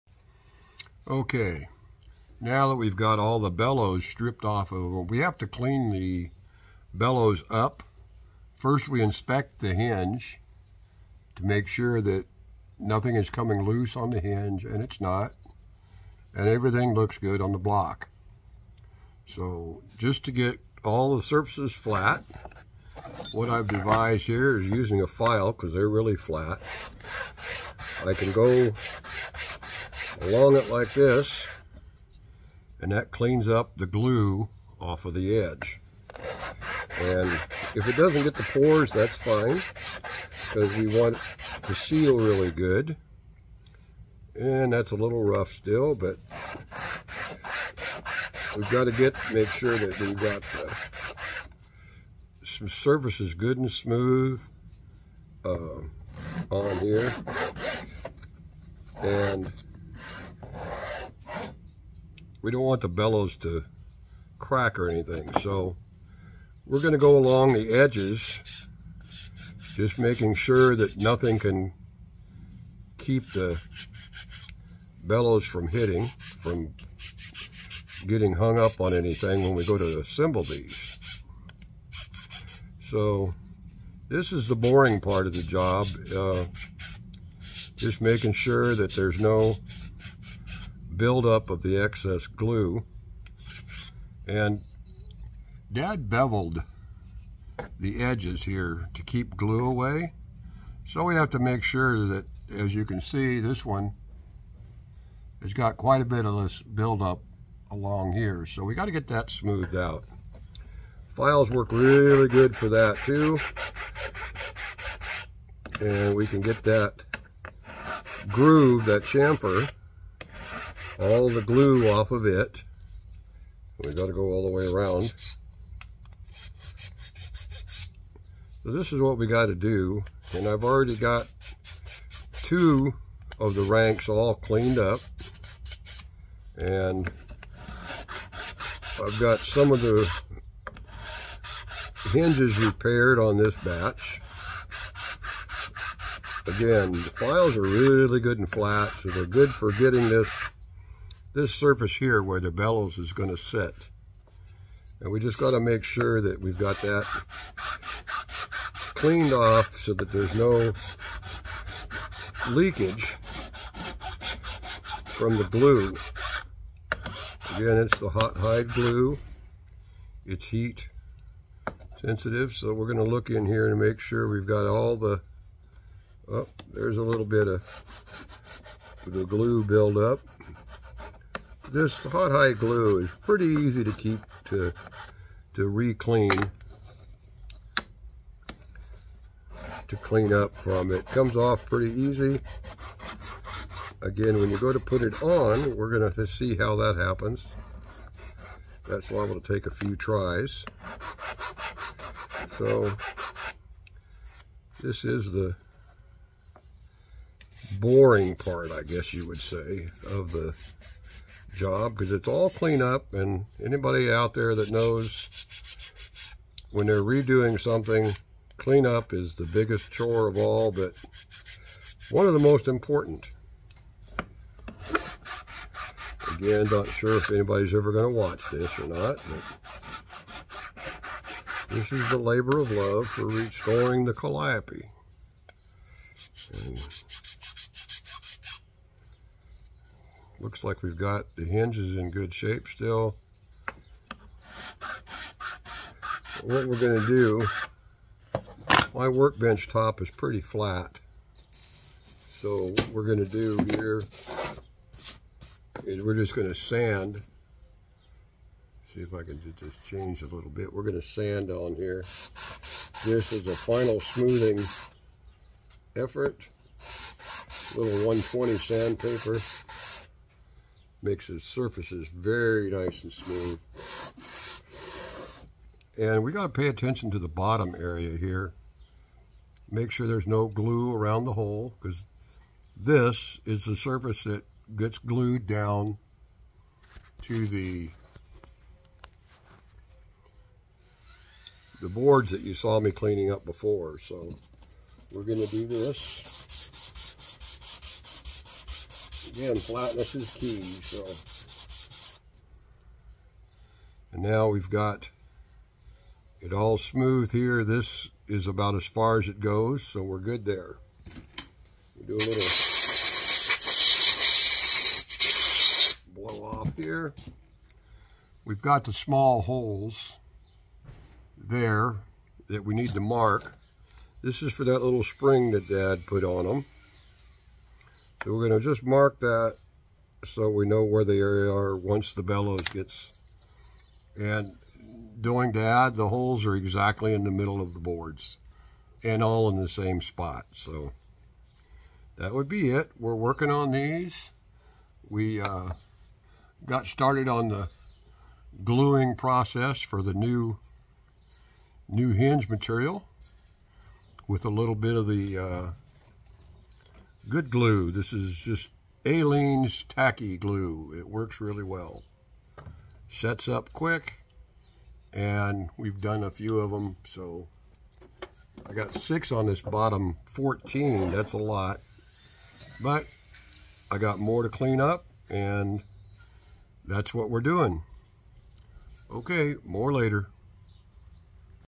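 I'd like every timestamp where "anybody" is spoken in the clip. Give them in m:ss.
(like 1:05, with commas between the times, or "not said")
3:33, 3:47.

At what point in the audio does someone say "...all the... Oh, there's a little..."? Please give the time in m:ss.
2:54.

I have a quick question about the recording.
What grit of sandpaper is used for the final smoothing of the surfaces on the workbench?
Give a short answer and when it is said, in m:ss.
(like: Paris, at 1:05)
120, at 4:28.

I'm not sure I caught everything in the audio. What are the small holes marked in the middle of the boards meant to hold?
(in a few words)
little spring.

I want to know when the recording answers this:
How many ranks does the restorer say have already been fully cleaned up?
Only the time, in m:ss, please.
2:12.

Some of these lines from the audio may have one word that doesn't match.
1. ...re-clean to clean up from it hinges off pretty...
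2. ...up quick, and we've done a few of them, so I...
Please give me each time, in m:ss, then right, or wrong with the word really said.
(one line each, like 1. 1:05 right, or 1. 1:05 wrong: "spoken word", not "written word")
1. 3:05 wrong: "comes", not "hinges"
2. 6:03 right.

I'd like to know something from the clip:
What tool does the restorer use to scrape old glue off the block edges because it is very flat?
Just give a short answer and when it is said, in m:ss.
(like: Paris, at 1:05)
file, at 0:24.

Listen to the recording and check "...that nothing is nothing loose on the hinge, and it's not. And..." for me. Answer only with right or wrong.
wrong.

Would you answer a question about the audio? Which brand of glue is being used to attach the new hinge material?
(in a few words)
Aleene's Tacky Glue.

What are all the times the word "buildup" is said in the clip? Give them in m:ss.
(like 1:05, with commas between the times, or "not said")
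1:31, 1:46, 2:59.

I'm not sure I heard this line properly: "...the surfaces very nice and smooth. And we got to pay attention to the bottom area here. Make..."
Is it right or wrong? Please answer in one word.
right.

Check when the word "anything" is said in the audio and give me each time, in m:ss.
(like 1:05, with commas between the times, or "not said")
1:04, 1:18.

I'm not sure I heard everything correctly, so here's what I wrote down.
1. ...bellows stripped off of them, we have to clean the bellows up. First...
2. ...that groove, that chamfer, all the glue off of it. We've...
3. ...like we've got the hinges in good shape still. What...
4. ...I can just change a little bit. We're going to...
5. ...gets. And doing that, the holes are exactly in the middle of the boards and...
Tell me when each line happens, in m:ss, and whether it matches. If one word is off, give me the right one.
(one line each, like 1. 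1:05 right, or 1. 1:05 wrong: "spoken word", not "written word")
1. 0:03 right
2. 1:56 right
3. 4:00 right
4. 4:19 right
5. 5:32 right.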